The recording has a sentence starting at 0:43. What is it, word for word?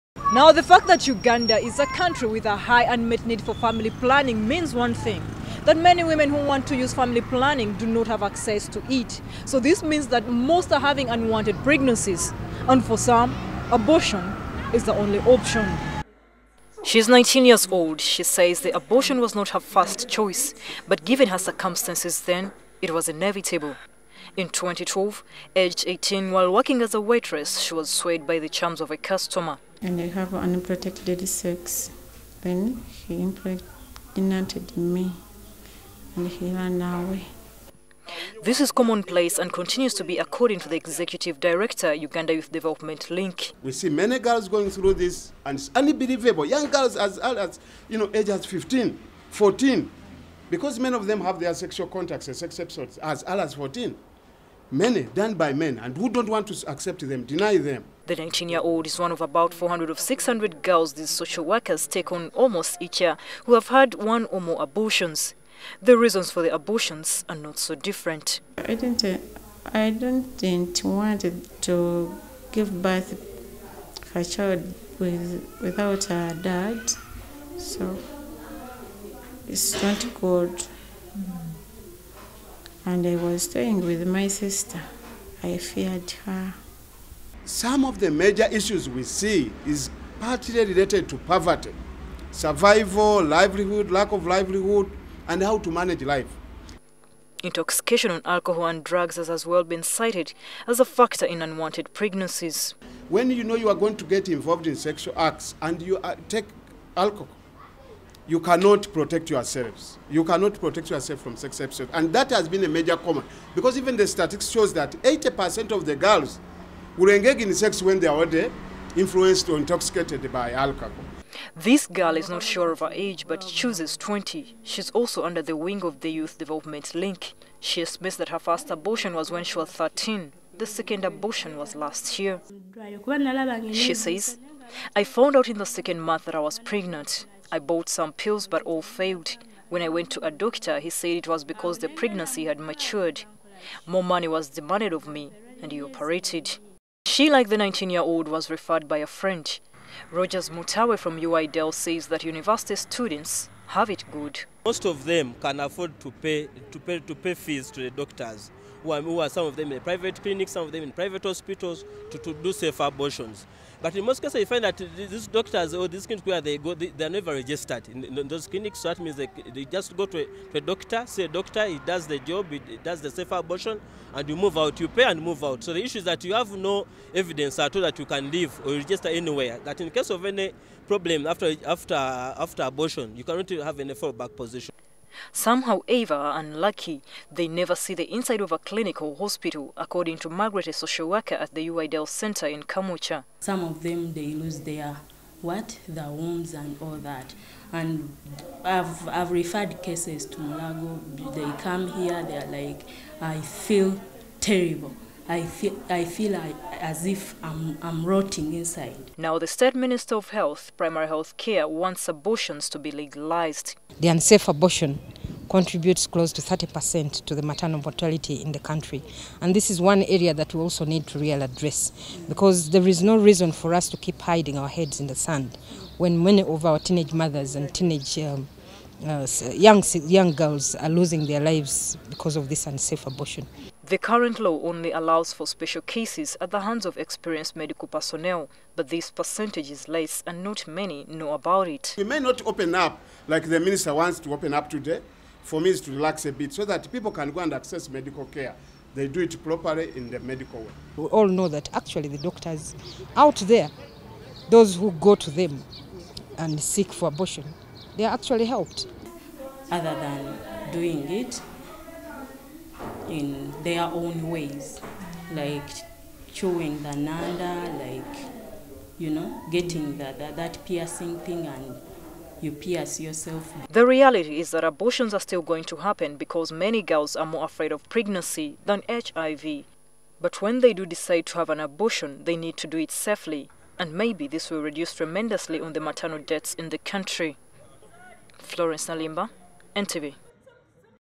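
We see many girls going through this and it's unbelievable.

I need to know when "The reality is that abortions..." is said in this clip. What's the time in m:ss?
4:33.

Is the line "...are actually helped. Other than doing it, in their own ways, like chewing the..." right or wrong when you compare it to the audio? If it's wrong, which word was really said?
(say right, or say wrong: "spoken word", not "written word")
right.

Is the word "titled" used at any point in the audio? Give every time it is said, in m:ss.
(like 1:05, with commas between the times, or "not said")
not said.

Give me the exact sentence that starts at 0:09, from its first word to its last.
So, this means that most are having unwanted pregnancies, and for some, abortion is the only option.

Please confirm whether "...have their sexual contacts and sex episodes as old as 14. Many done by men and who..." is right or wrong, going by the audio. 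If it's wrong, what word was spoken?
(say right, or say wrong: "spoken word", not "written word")
right.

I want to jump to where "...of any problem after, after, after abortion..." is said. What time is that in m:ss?
3:00.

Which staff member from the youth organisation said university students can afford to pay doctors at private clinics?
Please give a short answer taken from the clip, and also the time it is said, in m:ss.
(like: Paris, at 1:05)
Rogers Mutawe, at 2:30.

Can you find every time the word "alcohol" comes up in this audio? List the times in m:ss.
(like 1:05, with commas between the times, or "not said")
1:38, 1:46, 2:00.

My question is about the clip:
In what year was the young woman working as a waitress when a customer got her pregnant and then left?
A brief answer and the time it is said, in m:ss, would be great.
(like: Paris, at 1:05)
2012, at 0:24.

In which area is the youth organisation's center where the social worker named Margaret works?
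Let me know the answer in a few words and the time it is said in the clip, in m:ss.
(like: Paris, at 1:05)
Kamwokya, at 3:12.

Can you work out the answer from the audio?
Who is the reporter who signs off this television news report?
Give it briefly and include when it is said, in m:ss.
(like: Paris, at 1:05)
Florence Naluyimba, at 4:48.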